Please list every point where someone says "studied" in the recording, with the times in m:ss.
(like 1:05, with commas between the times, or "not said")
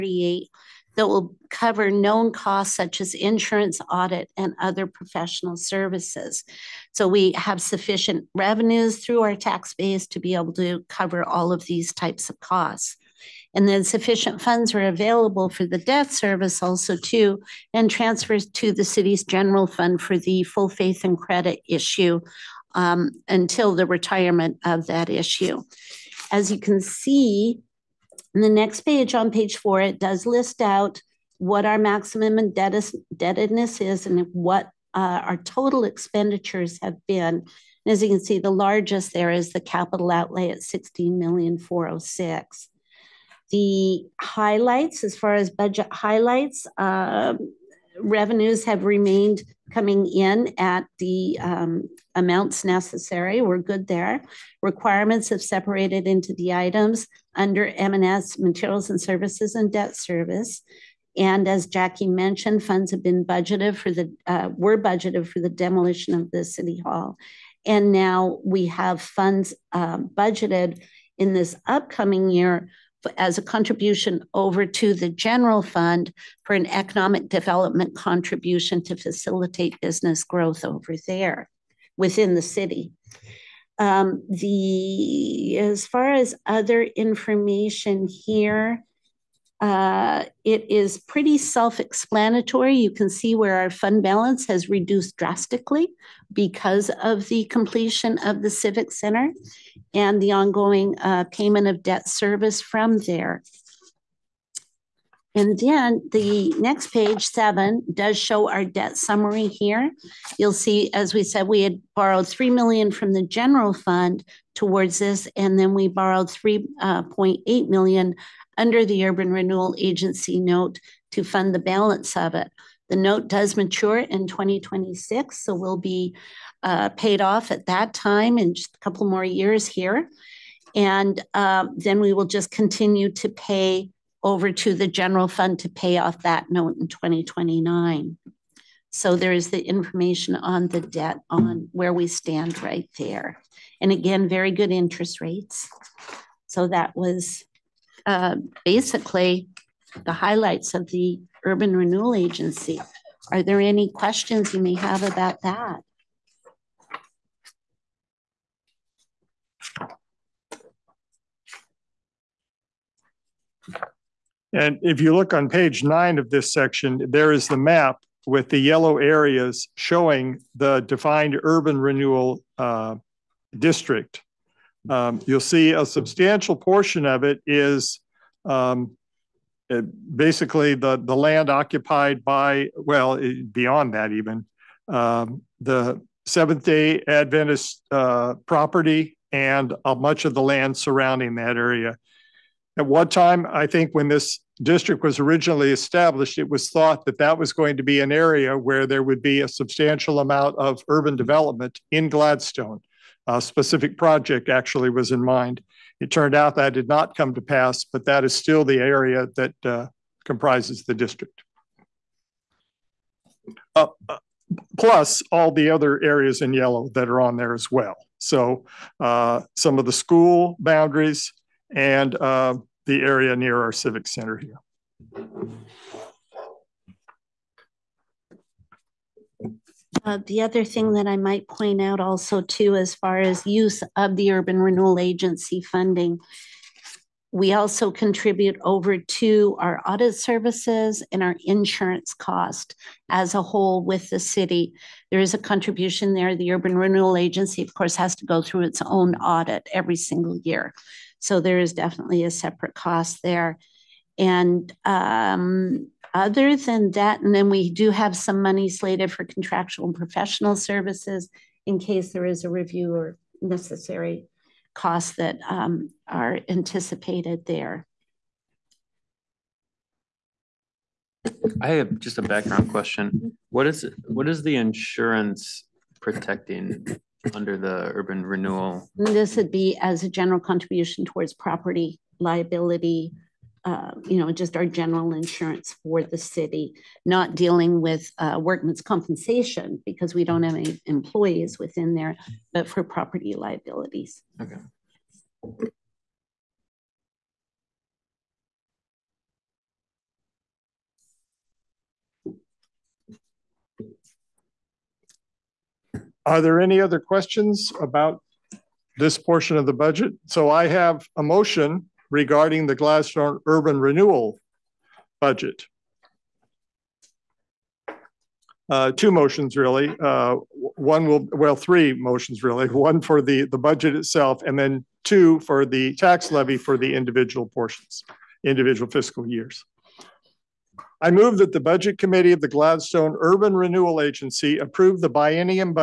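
not said.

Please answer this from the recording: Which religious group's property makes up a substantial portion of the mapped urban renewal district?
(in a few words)
Seventh-day Adventist.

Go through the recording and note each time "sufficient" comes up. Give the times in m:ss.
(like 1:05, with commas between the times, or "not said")
0:07, 0:13.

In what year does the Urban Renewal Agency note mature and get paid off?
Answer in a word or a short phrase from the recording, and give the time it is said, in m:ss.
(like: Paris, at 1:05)
2026, at 2:04.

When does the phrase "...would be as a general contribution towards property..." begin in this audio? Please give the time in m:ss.
4:39.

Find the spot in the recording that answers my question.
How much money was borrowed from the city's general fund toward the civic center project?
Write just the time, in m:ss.
1:52.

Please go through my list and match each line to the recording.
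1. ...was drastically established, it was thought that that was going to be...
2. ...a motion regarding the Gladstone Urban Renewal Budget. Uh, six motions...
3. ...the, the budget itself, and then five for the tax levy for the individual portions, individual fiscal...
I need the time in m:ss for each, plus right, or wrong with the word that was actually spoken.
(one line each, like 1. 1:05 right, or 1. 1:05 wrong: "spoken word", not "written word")
1. 3:15 wrong: "originally", not "drastically"
2. 5:11 wrong: "two", not "six"
3. 5:23 wrong: "two", not "five".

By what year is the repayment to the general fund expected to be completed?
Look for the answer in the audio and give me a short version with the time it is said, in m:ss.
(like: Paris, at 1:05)
2029, at 2:16.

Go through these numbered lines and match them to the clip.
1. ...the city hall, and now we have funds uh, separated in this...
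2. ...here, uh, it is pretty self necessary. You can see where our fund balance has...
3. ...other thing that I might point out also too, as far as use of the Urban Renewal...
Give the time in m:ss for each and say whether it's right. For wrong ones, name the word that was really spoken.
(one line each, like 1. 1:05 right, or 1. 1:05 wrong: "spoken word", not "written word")
1. 1:06 wrong: "budgeted", not "separated"
2. 1:28 wrong: "explanatory", not "necessary"
3. 3:50 right.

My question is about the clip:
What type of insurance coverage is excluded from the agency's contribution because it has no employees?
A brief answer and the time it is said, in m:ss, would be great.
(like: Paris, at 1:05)
workman's compensation, at 4:48.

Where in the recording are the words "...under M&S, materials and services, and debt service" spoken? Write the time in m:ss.
0:57.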